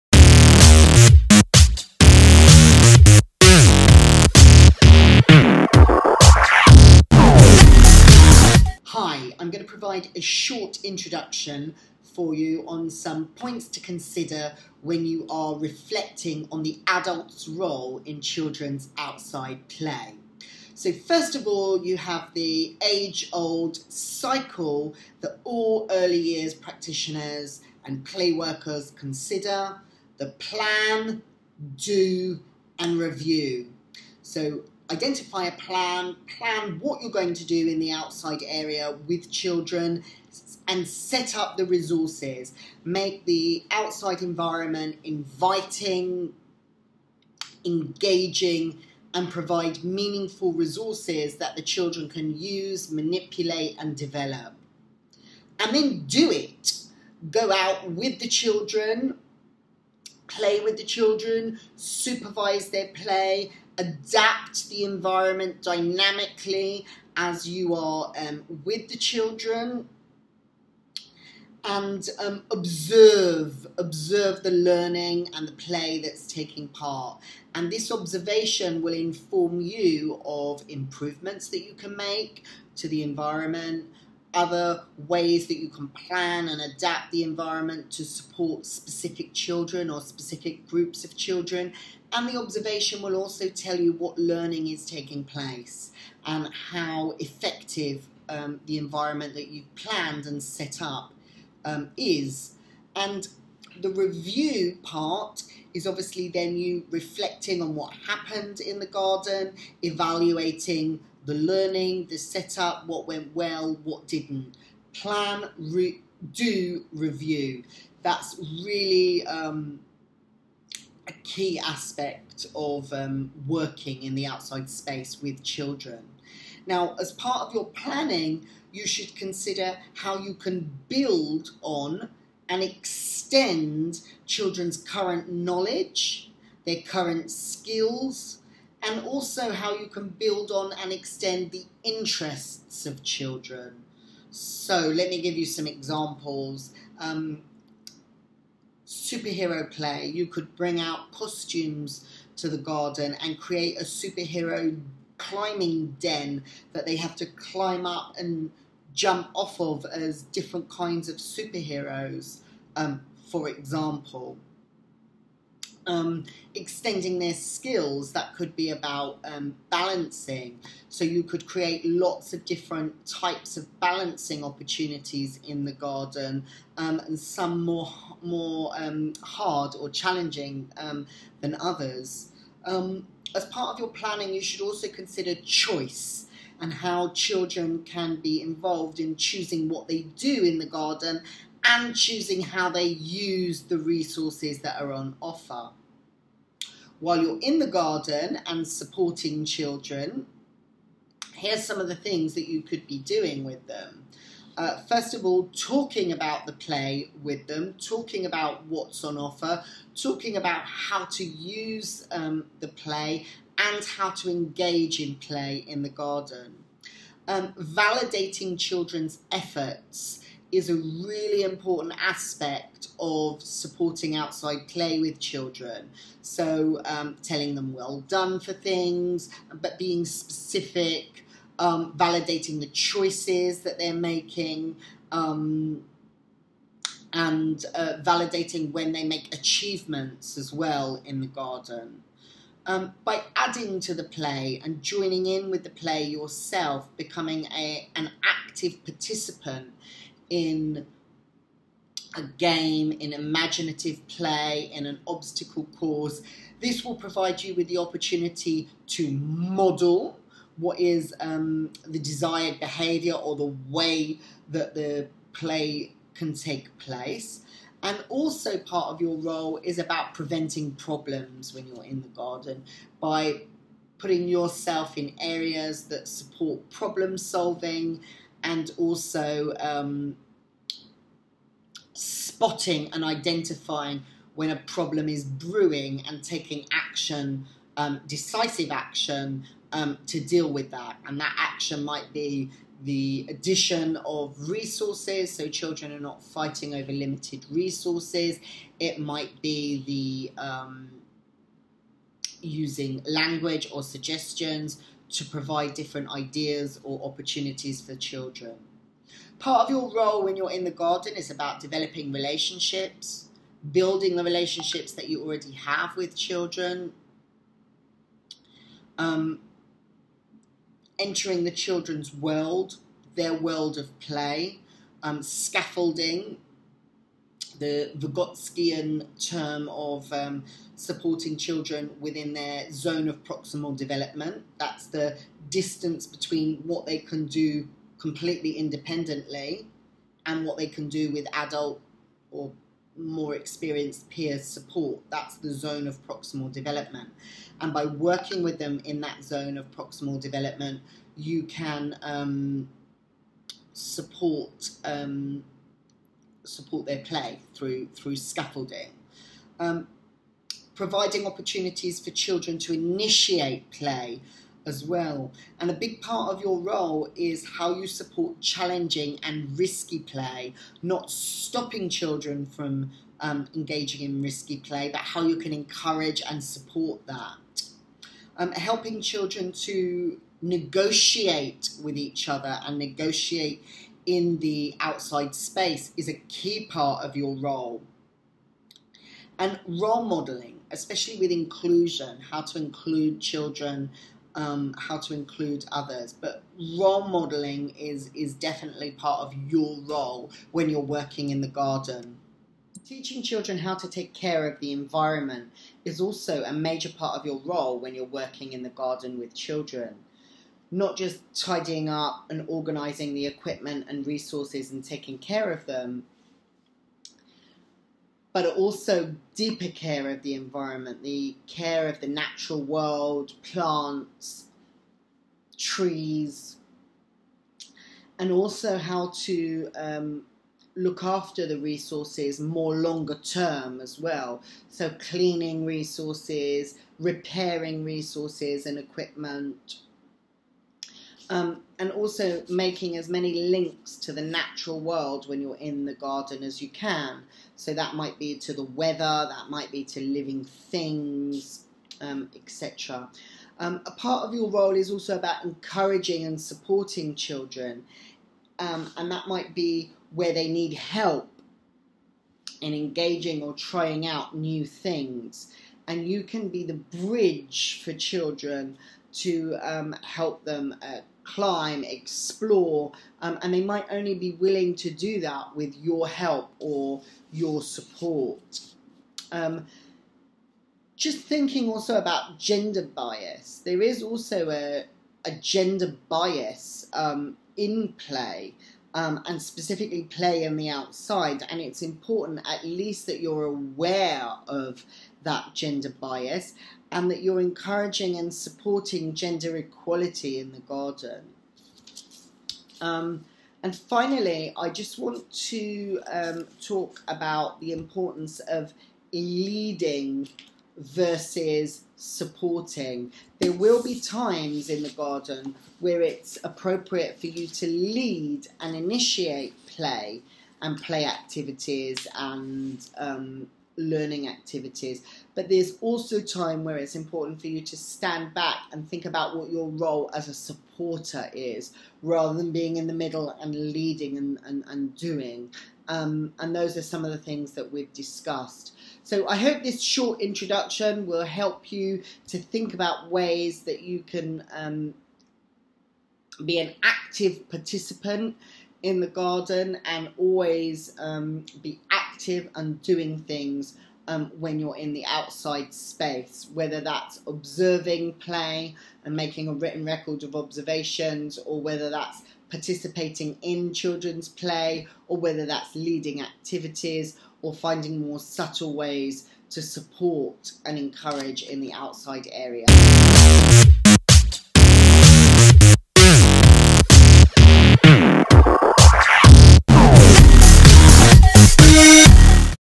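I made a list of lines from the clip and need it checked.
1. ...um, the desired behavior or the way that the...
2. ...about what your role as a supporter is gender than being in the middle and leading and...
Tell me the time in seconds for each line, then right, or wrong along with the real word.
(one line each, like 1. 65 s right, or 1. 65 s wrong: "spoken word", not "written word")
1. 261 s right
2. 529 s wrong: "rather", not "gender".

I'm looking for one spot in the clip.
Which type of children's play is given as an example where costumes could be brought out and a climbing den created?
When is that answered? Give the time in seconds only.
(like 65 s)
148 s.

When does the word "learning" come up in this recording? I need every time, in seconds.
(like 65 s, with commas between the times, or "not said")
74 s, 94 s, 111 s, 523 s.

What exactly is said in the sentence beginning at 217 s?
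Um, validating children's efforts is a really important aspect of supporting outside play with children.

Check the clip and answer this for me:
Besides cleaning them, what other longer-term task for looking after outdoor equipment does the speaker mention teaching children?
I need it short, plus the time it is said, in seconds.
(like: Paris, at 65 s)
Repairing resources, at 436 s.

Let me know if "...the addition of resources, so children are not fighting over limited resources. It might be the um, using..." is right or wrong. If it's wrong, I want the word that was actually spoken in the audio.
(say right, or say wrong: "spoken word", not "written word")
right.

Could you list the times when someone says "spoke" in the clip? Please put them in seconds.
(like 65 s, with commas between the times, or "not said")
not said.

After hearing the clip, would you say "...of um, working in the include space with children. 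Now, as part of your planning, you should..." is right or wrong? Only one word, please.
wrong.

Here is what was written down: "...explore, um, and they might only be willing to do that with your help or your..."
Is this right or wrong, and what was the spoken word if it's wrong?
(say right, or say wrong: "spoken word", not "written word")
right.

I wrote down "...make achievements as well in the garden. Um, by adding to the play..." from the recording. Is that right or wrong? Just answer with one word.
right.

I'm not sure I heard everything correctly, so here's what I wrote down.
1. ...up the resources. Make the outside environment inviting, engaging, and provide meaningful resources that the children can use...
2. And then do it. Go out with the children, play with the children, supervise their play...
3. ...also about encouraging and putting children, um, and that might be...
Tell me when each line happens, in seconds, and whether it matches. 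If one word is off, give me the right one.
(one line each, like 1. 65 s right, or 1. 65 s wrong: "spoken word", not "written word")
1. 41 s right
2. 55 s right
3. 454 s wrong: "supporting", not "putting".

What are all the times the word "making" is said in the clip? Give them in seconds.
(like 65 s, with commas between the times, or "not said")
233 s, 442 s, 559 s.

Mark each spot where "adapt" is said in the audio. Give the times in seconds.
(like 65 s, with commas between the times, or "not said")
63 s, 86 s.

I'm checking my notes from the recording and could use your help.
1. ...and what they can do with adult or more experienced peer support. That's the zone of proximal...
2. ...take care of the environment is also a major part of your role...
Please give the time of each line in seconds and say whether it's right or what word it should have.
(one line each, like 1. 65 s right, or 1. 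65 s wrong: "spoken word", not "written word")
1. 340 s right
2. 403 s right.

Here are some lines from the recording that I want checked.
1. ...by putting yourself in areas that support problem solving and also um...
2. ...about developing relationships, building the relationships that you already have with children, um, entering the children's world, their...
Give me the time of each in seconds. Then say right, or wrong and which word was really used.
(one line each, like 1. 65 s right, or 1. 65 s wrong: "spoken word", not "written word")
1. 273 s right
2. 311 s right.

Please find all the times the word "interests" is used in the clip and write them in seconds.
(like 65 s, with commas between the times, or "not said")
141 s.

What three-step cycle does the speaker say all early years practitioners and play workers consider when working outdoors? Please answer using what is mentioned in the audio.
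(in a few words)
Plan, do, and review.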